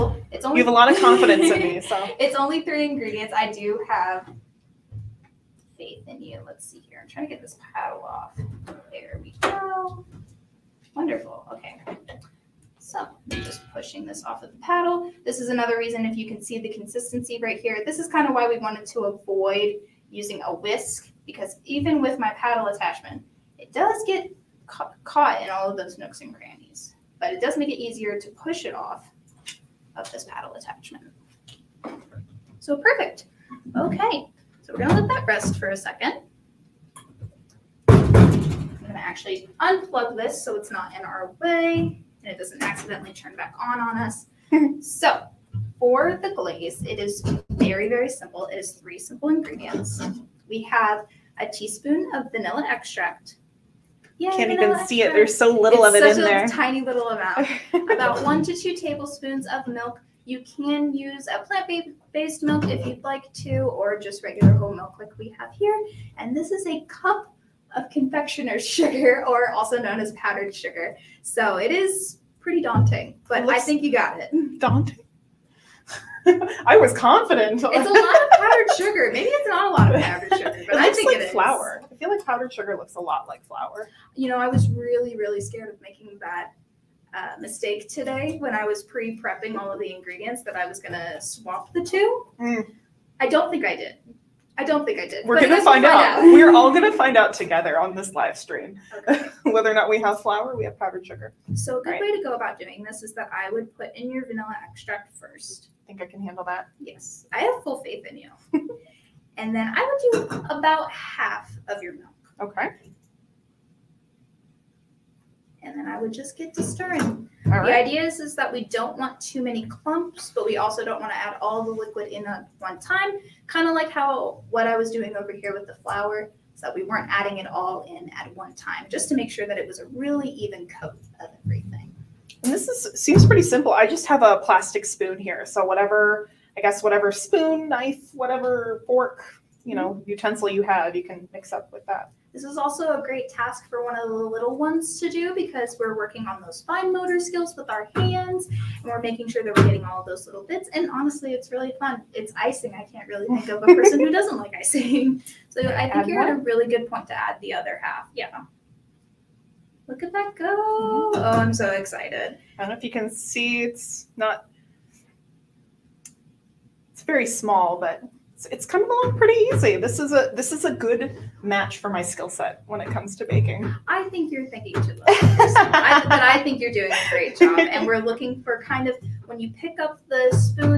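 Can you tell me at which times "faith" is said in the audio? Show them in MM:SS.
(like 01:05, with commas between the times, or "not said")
00:05, 01:47.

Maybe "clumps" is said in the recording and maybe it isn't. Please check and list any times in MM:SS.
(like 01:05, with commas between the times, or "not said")
01:59.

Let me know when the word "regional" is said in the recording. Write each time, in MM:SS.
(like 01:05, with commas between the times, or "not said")
not said.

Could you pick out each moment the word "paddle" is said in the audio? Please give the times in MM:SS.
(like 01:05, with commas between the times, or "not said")
00:07, 00:14, 00:22, 00:30.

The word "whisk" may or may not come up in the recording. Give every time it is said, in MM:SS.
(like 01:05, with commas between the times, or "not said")
00:20.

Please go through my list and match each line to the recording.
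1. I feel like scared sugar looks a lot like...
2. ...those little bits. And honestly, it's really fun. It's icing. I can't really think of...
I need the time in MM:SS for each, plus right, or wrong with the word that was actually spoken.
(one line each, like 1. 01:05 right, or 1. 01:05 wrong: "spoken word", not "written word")
1. 01:21 wrong: "powdered", not "scared"
2. 02:30 right.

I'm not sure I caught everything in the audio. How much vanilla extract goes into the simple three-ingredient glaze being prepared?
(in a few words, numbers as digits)
1 teaspoon.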